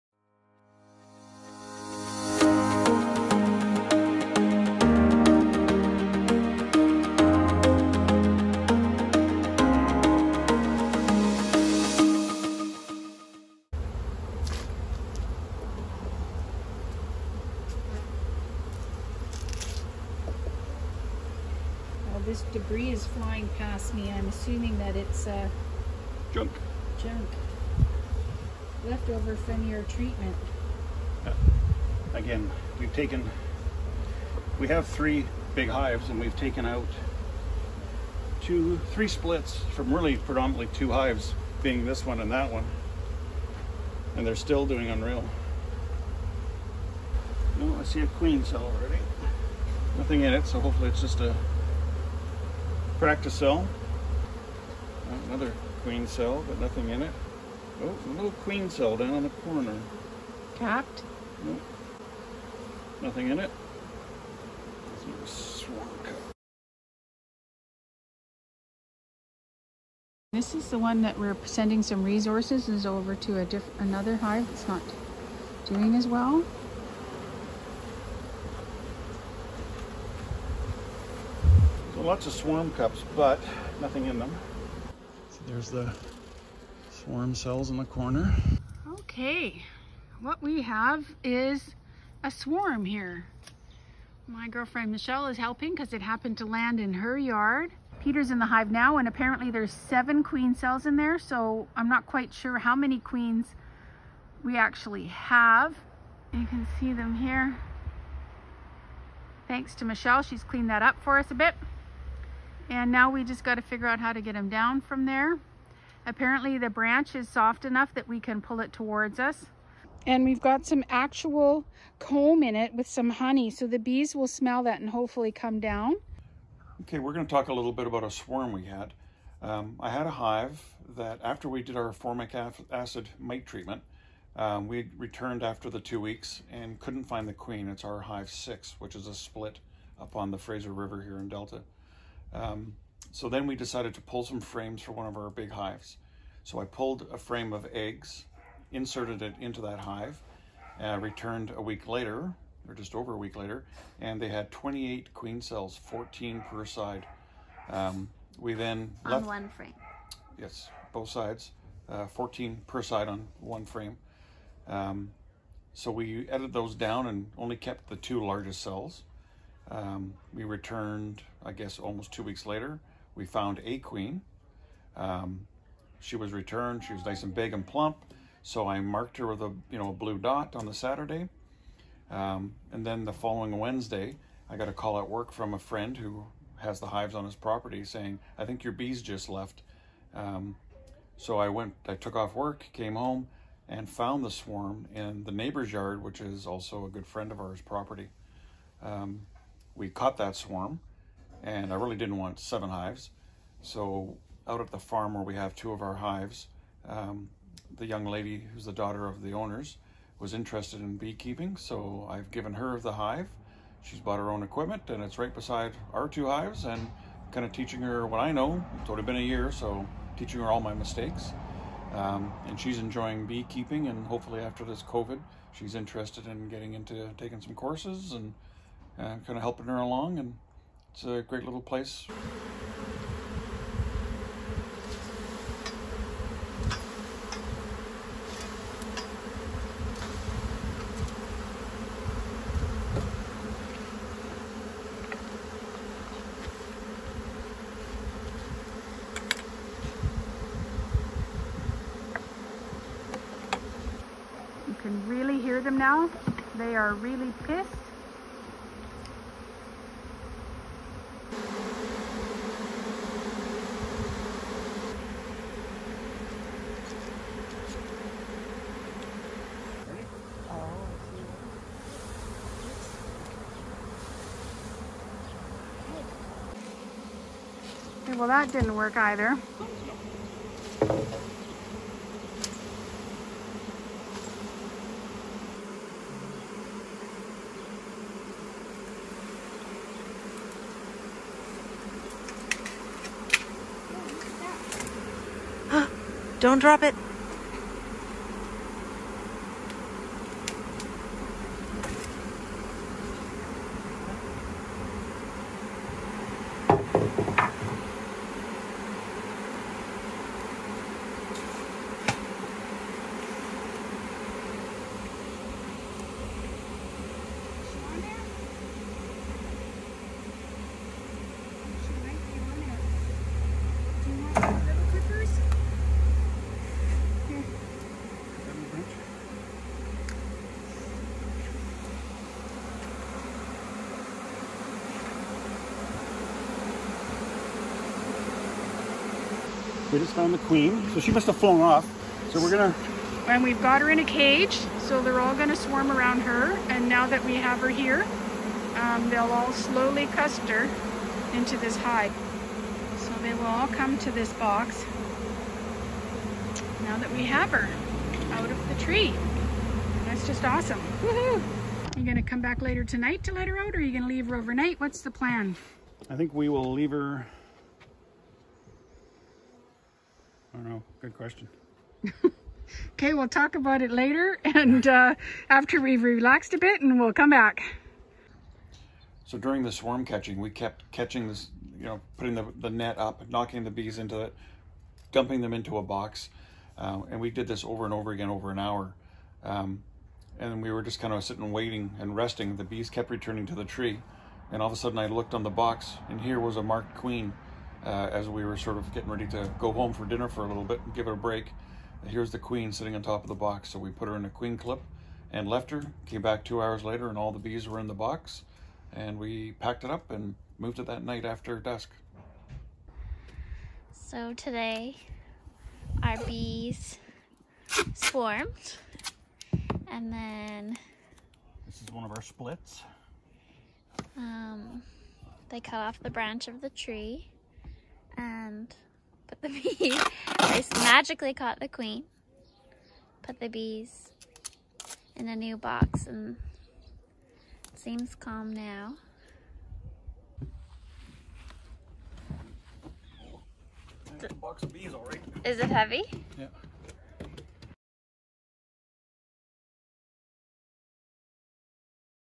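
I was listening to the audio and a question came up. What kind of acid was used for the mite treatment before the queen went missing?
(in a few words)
Formic acid.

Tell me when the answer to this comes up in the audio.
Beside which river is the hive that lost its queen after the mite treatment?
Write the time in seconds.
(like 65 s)
140 s.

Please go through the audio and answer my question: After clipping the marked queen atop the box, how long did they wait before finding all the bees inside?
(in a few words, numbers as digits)
2 hours.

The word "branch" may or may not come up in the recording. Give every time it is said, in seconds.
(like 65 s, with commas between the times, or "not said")
116 s, 426 s.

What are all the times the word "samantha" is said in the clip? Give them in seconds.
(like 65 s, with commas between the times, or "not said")
not said.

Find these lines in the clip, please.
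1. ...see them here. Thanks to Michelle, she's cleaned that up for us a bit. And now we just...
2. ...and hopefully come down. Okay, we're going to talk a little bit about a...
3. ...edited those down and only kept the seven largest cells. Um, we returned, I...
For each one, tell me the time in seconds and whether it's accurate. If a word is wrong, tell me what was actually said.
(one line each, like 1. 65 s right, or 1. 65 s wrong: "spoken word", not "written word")
1. 106 s right
2. 124 s right
3. 166 s wrong: "two", not "seven".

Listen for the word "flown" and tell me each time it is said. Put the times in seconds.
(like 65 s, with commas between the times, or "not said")
341 s.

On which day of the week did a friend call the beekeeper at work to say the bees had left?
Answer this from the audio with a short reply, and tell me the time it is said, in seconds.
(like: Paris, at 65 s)
Wednesday, at 183 s.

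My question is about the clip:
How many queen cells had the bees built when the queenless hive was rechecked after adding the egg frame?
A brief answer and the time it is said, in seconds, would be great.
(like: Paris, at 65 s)
28, at 154 s.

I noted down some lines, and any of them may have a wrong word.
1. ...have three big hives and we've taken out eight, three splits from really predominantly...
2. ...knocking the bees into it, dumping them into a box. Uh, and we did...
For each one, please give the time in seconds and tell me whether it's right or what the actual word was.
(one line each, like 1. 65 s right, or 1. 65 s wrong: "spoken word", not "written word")
1. 34 s wrong: "two", not "eight"
2. 383 s right.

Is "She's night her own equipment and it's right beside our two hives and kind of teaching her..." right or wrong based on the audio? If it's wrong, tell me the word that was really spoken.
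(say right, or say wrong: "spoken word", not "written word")
wrong: "bought", not "night".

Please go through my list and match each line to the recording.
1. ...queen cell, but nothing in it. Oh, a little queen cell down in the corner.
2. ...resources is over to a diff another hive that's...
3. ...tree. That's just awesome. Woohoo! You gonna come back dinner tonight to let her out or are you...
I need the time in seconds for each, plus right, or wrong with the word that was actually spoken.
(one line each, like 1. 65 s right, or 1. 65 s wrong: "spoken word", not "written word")
1. 55 s right
2. 72 s right
3. 358 s wrong: "later", not "dinner".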